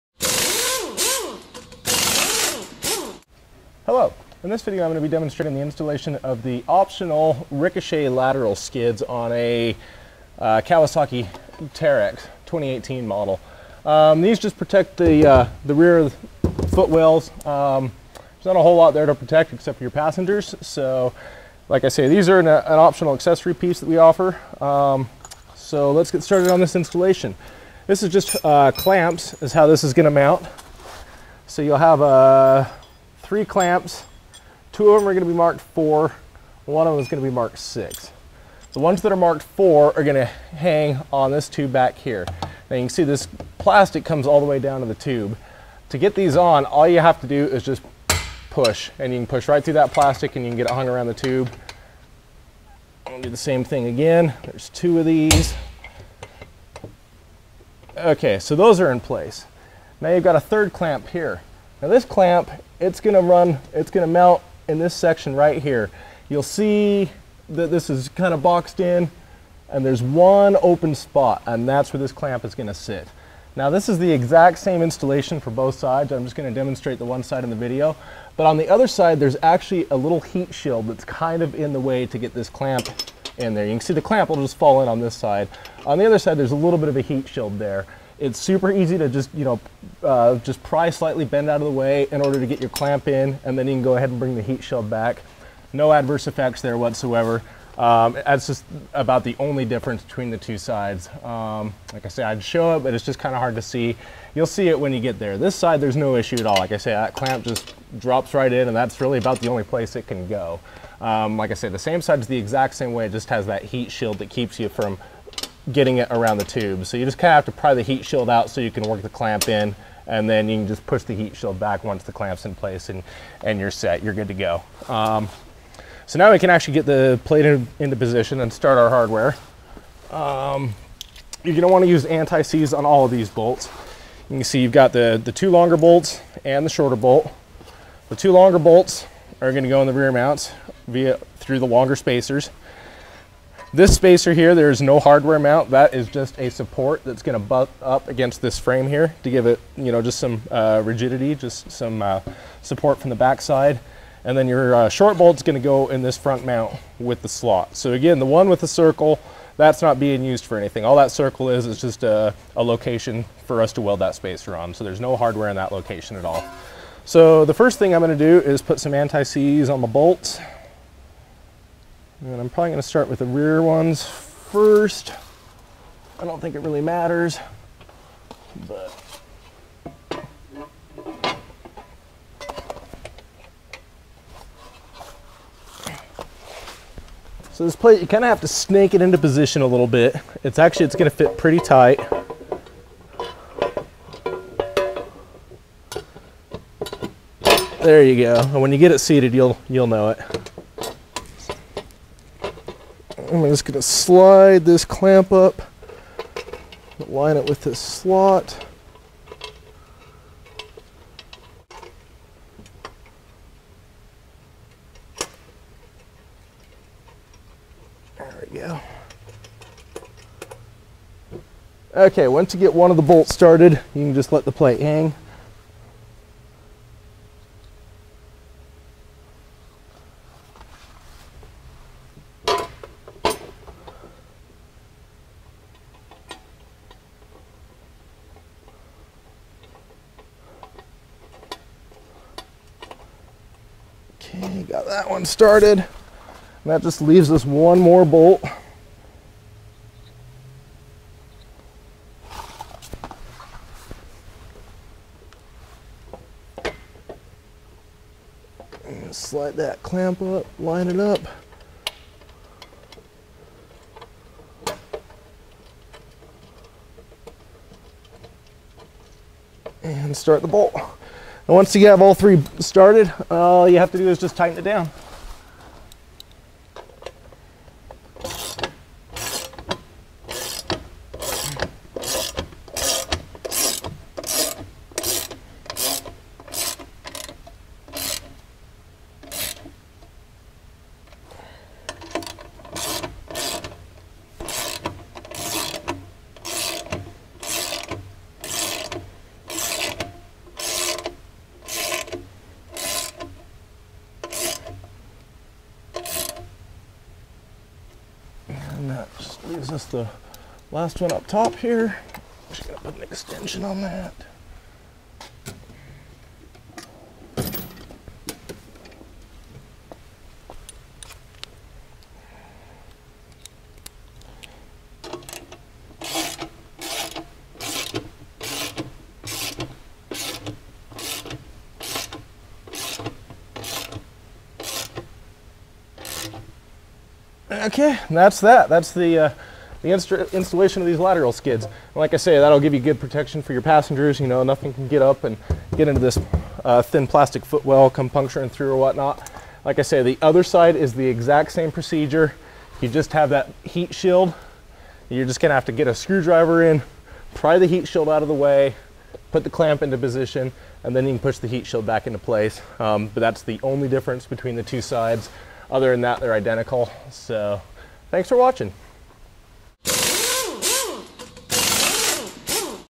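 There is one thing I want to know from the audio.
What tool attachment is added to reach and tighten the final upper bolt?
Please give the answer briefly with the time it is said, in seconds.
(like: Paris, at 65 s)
an extension, at 313 s.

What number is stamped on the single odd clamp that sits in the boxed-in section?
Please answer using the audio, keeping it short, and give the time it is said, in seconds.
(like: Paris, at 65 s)
6, at 37 s.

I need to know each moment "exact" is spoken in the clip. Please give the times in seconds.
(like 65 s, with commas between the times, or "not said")
74 s, 112 s, 351 s.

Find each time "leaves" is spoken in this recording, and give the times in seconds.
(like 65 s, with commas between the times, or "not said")
247 s, 309 s.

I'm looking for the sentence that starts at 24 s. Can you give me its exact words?
Um, so let's get started on this installation.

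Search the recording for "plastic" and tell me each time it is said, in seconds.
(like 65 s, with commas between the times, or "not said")
43 s, 49 s, 347 s.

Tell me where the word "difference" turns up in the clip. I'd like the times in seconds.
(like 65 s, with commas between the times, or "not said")
99 s, 363 s.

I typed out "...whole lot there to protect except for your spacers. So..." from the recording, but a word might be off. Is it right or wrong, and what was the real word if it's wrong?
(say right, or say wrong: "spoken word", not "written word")
wrong: "passengers", not "spacers".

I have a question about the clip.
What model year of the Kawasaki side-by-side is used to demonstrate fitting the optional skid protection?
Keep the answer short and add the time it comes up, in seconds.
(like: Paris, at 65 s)
2018, at 12 s.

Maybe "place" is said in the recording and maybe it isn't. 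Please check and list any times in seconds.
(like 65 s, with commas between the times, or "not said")
58 s, 109 s, 122 s, 362 s.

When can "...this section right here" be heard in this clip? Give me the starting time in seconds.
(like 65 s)
64 s.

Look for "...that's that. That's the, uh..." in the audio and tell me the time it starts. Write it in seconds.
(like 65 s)
338 s.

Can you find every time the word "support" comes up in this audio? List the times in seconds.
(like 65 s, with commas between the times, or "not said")
146 s, 152 s.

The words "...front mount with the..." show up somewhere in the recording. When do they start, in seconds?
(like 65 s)
156 s.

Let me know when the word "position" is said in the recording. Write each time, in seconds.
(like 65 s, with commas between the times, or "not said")
127 s, 189 s, 359 s.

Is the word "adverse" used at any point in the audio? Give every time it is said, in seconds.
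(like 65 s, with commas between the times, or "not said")
95 s.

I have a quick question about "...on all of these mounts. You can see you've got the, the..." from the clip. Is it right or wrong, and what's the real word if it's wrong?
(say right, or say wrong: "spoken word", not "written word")
wrong: "bolts", not "mounts".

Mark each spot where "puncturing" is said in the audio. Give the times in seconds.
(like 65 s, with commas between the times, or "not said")
348 s.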